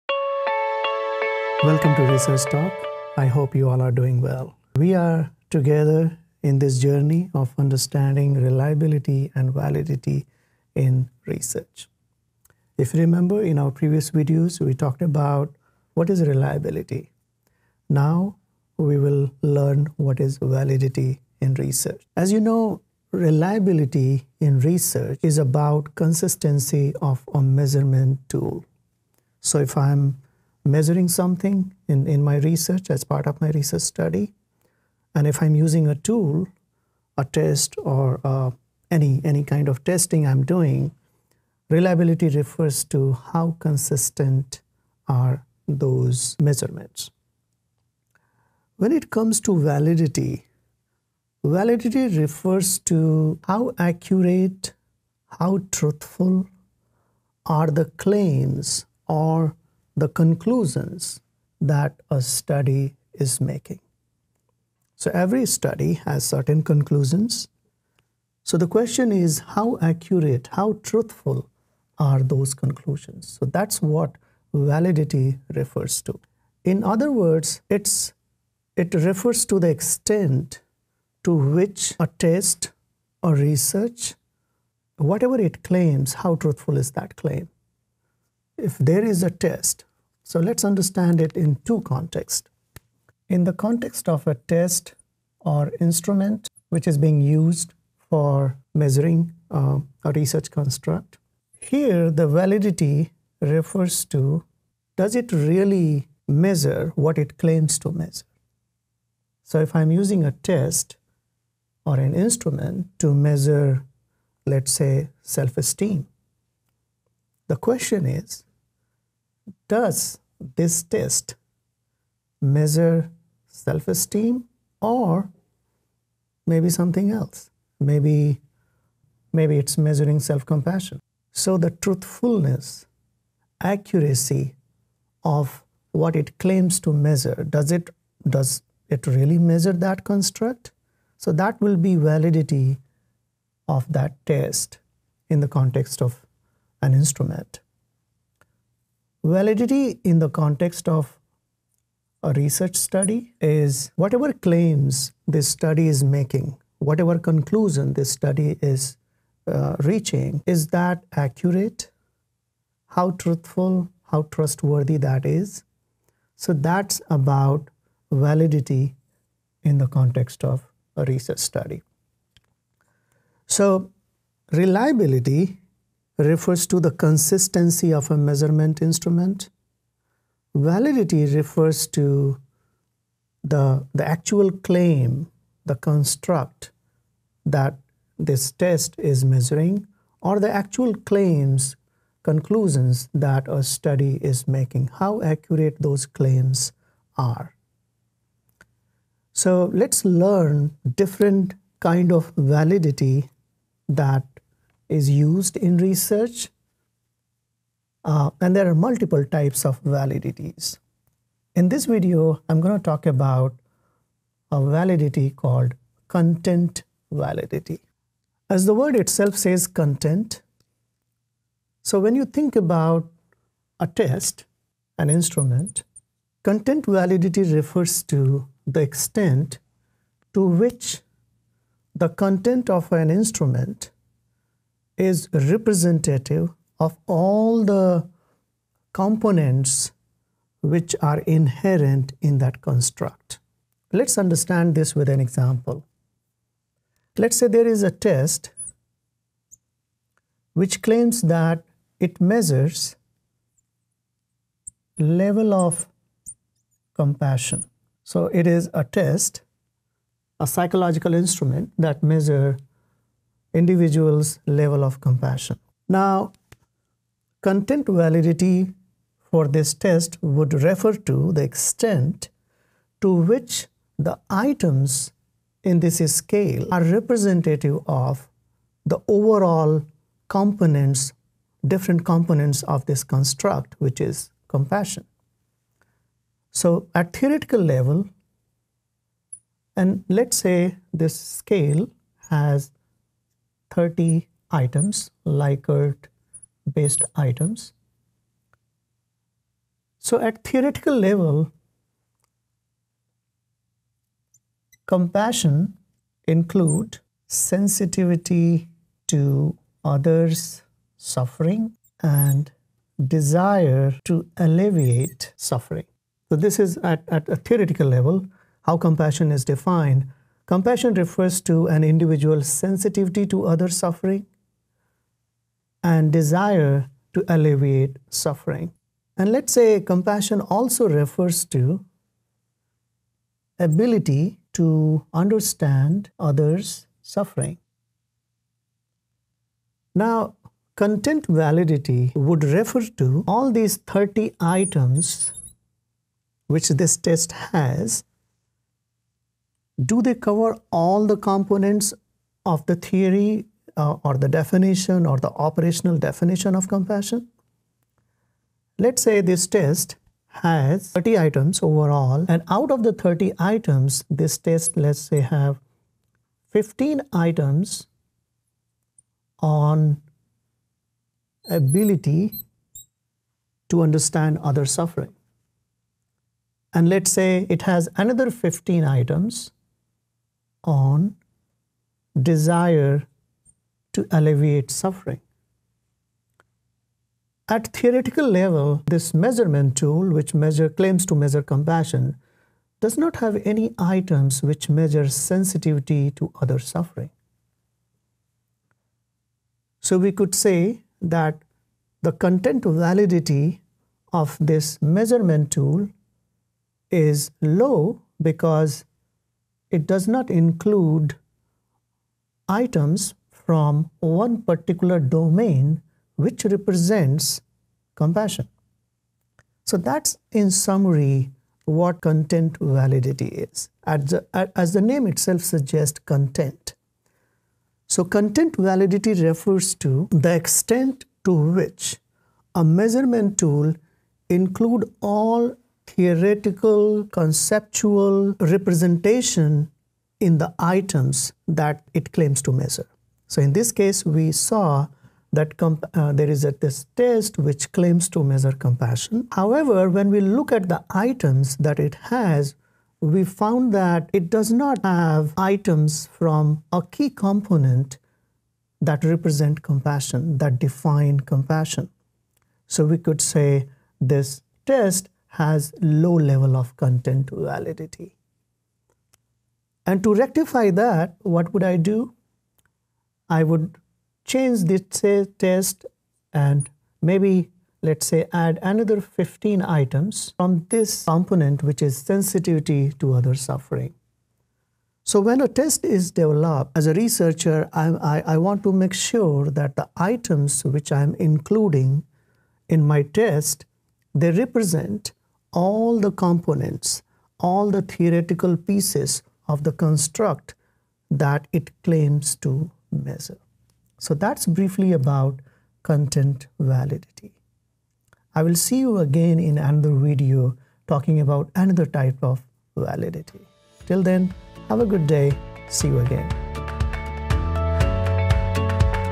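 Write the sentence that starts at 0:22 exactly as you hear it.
As you know, reliability in research is about consistency of a measurement tool.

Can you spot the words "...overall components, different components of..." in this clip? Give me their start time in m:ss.
4:39.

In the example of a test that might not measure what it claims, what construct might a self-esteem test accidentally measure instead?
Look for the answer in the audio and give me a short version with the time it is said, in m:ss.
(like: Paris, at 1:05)
self compassion, at 2:10.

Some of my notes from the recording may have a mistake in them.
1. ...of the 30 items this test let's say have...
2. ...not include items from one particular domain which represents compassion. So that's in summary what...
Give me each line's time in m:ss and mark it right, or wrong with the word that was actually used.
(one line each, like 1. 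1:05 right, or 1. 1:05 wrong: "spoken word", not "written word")
1. 6:02 right
2. 6:50 right.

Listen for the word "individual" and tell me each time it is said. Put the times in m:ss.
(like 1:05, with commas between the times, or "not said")
4:23, 5:21.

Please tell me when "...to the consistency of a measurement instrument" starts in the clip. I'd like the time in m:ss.
2:56.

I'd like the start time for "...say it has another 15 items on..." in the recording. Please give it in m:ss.
6:17.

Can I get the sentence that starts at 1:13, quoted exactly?
So that's what validity refers to.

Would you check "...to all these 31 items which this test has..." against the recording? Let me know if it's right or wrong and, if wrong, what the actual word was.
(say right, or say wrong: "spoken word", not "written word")
wrong: "30", not "31".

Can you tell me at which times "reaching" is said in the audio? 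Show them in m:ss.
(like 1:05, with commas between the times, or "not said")
2:39.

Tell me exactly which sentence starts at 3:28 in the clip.
Uh, and there are multiple types of validities.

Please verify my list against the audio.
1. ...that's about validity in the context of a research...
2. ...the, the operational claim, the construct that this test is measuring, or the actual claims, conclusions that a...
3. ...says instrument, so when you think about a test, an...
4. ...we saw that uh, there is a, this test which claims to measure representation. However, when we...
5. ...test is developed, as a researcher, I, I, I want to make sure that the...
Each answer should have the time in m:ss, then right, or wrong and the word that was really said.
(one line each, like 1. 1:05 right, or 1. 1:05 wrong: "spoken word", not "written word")
1. 2:46 right
2. 3:03 wrong: "actual", not "operational"
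3. 3:39 wrong: "content", not "instrument"
4. 7:24 wrong: "compassion", not "representation"
5. 8:05 right.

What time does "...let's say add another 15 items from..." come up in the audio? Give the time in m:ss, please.
7:57.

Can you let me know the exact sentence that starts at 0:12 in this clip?
If you remember in our previous videos, we talked about what is reliability.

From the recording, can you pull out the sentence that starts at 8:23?
So that's briefly about content validity.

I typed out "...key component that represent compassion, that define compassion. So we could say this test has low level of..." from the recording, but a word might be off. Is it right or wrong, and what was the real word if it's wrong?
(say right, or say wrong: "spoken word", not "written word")
right.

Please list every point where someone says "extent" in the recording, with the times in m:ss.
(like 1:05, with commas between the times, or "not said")
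1:19, 3:48, 4:31, 7:10.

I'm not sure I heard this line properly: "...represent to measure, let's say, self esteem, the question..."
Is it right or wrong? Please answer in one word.
wrong.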